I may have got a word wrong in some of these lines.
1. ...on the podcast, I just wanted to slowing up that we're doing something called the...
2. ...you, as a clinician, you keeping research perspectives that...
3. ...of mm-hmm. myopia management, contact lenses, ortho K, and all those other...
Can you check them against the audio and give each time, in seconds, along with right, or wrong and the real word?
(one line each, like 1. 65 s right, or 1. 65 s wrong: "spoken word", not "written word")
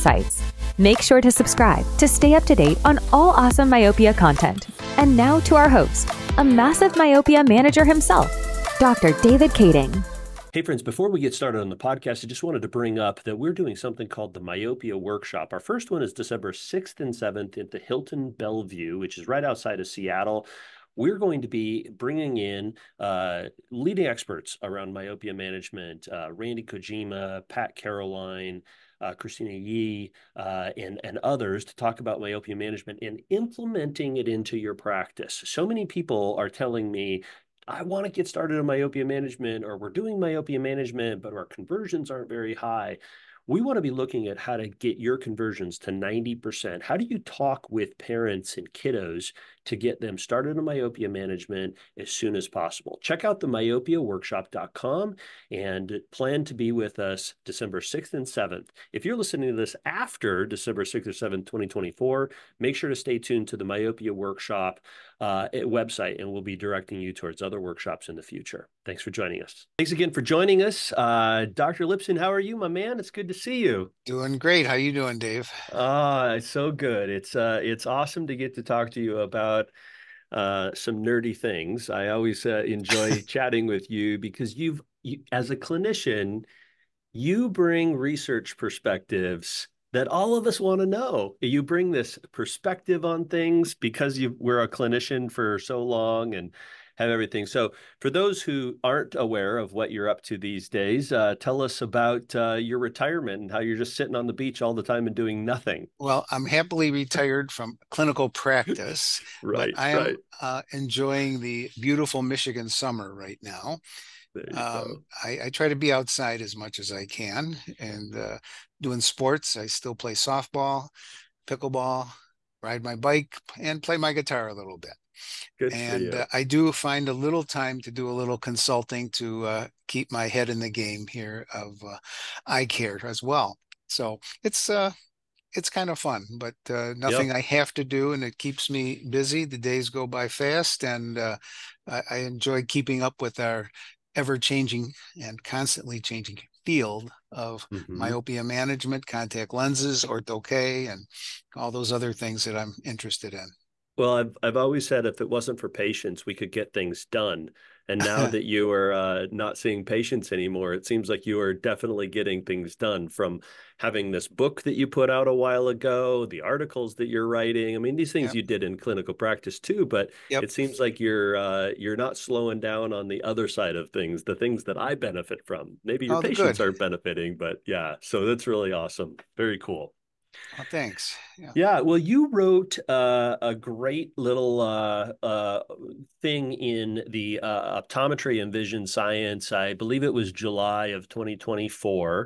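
1. 11 s wrong: "bring", not "slowing"
2. 85 s wrong: "bring", not "keeping"
3. 147 s right.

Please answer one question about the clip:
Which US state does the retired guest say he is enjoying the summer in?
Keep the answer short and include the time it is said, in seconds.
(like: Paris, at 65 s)
Michigan, at 112 s.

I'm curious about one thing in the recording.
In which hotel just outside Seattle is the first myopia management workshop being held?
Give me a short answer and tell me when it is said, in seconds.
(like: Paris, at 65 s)
Hilton Bellevue, at 17 s.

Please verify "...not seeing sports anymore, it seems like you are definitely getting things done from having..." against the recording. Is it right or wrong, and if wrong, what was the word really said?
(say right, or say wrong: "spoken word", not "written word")
wrong: "patients", not "sports".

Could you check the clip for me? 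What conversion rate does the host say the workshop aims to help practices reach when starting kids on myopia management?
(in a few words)
90%.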